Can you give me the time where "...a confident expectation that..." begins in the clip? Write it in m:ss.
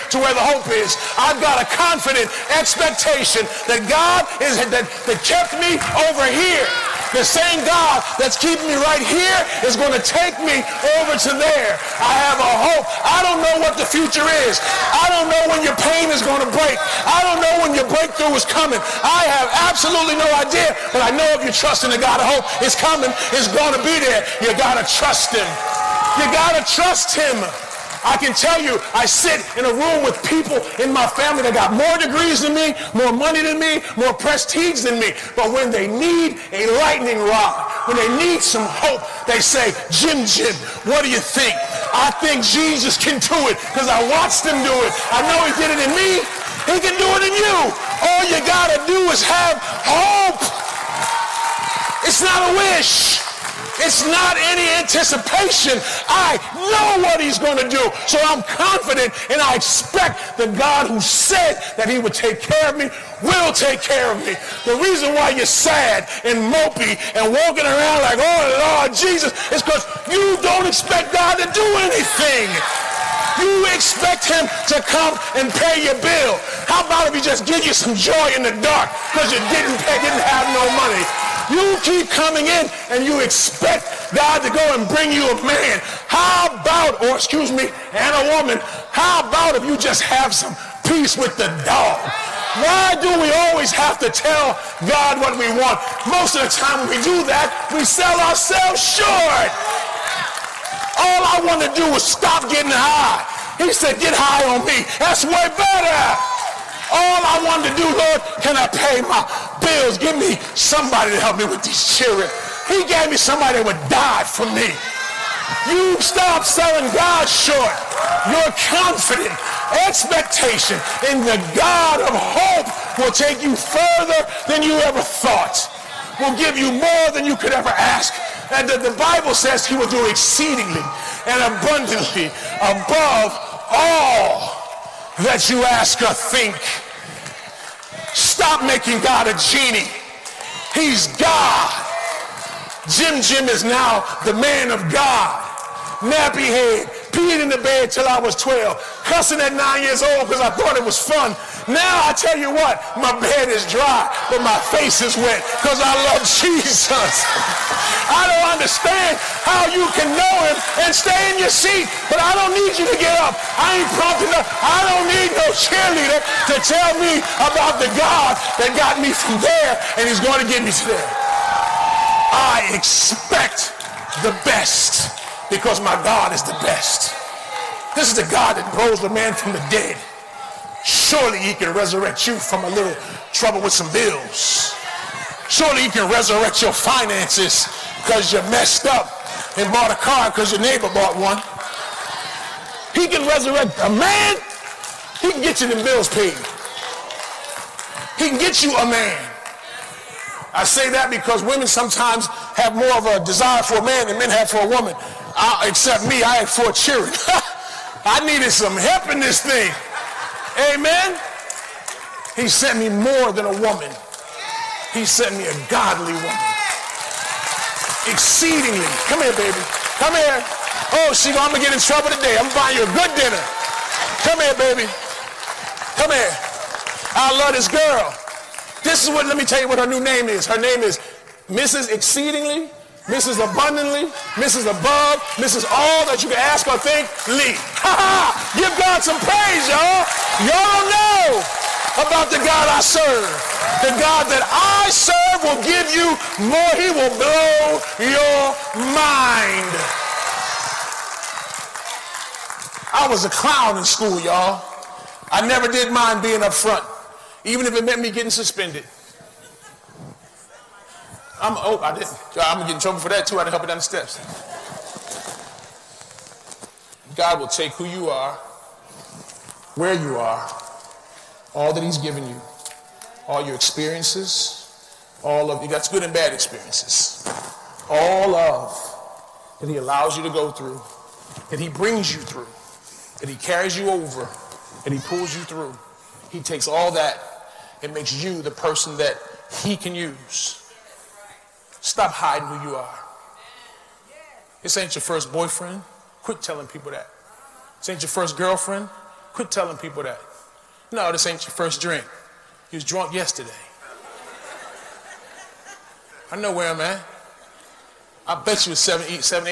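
0:01.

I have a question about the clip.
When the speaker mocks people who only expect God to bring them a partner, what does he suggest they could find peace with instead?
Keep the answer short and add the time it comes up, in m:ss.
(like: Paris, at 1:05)
the dog, at 1:31.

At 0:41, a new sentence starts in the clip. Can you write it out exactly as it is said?
I think Jesus can do it because I watched him do it.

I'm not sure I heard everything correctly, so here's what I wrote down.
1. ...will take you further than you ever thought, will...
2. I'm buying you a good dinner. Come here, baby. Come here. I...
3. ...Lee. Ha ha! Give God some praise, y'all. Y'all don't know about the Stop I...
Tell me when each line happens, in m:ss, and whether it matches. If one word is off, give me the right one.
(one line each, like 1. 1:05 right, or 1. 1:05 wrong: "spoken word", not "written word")
1. 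2:03 right
2. 3:42 right
3. 3:57 wrong: "God", not "Stop".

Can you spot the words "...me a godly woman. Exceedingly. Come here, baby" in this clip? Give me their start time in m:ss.
3:35.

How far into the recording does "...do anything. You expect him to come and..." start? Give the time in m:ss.
1:11.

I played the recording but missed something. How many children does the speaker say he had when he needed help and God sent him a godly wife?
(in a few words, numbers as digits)
4.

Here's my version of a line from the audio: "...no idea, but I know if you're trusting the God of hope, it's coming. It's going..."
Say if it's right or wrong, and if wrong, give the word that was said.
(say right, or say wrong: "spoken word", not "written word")
right.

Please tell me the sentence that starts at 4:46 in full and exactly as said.
He takes all that and makes you the person that He can use Stop hiding who you are.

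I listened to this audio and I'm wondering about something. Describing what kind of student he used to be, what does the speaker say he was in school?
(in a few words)
a clown.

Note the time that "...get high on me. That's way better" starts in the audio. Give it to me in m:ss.
1:43.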